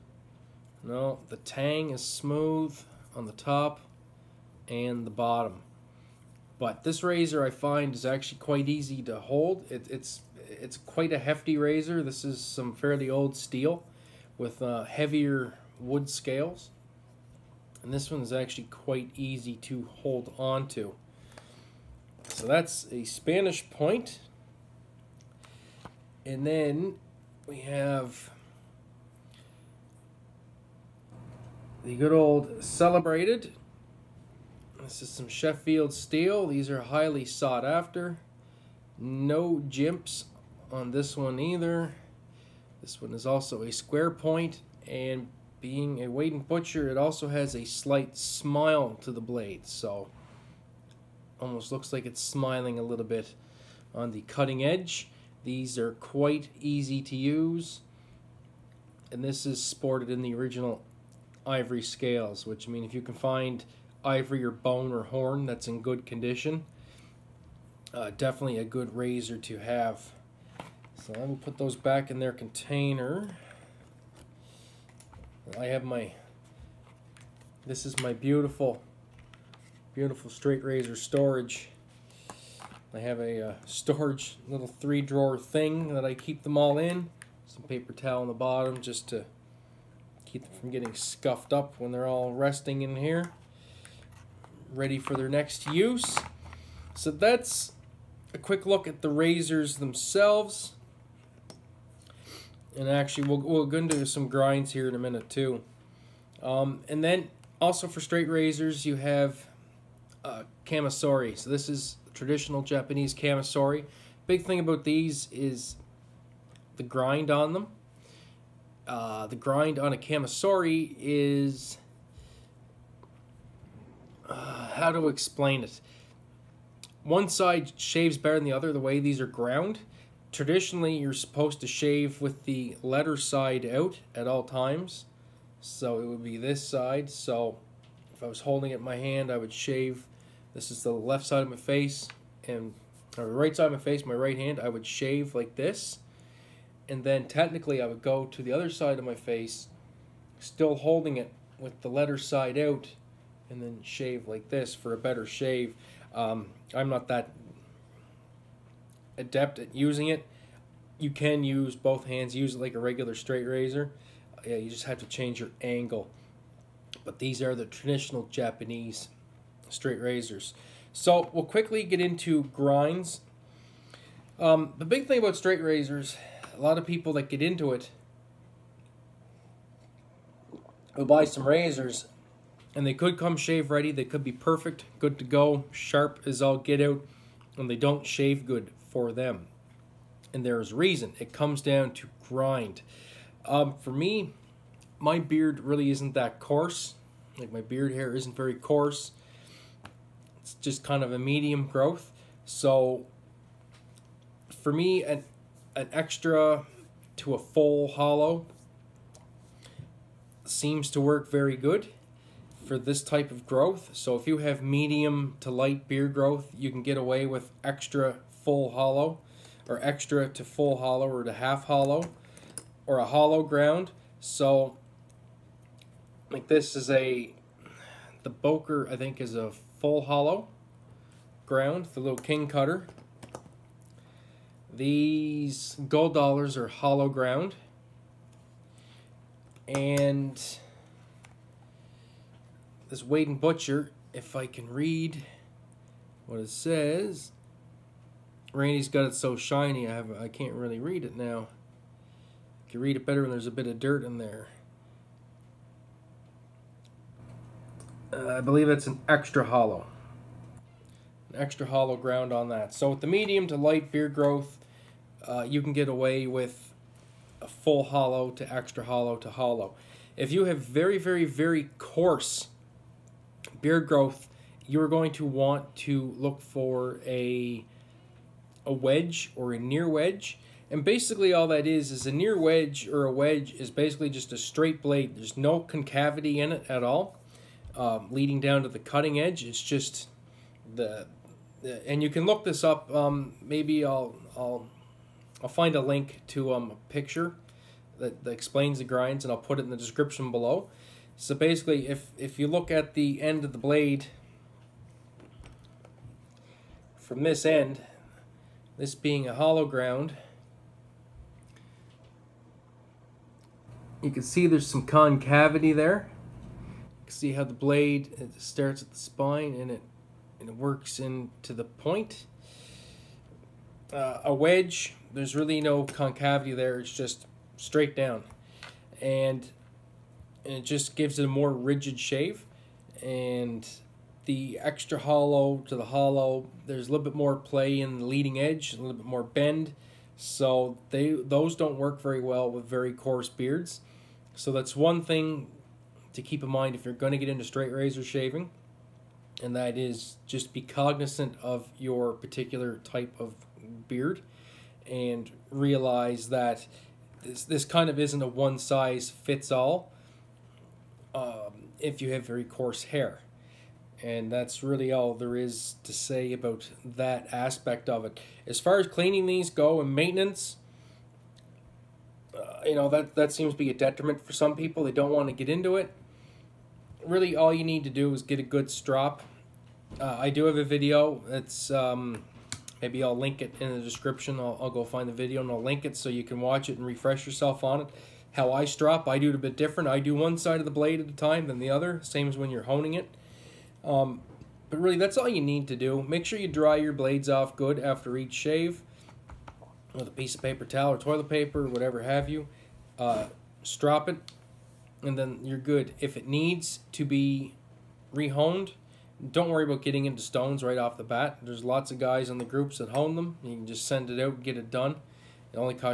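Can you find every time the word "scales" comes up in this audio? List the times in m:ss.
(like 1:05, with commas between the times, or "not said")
0:16, 1:01.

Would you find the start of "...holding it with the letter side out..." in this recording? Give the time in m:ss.
2:30.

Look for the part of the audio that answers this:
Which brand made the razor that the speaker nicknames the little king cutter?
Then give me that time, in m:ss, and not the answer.
3:48.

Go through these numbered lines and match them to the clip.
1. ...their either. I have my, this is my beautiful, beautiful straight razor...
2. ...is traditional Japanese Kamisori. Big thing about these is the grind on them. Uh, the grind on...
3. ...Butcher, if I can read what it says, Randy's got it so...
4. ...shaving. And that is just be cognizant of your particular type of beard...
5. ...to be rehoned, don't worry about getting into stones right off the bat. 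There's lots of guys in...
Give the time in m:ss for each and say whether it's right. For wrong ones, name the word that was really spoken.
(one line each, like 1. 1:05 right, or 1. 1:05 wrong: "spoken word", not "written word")
1. 1:12 wrong: "container", not "either"
2. 1:51 right
3. 4:03 right
4. 5:48 right
5. 6:46 right.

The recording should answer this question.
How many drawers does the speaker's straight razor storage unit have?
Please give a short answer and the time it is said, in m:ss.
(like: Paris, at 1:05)
3, at 1:24.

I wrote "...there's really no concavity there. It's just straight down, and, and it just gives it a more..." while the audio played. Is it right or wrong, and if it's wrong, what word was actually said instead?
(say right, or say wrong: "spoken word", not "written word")
right.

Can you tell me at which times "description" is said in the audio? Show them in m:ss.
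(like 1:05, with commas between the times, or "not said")
4:59, 6:23.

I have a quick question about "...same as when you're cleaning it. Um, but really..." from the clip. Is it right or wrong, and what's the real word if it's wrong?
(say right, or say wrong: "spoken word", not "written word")
wrong: "honing", not "cleaning".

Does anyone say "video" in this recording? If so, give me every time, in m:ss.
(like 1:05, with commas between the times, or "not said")
6:20, 6:25.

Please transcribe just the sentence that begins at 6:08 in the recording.
As far as cleaning these go and maintenance, uh, you know, that, that seems to be a detriment for some people.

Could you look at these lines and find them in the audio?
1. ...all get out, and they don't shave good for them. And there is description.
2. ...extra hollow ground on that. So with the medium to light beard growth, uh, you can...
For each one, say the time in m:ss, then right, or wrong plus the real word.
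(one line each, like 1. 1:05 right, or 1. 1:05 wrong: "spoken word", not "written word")
1. 3:06 wrong: "reason", not "description"
2. 4:21 right.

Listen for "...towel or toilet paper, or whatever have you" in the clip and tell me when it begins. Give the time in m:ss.
6:40.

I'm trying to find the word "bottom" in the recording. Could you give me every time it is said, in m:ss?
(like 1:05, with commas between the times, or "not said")
0:05, 1:28.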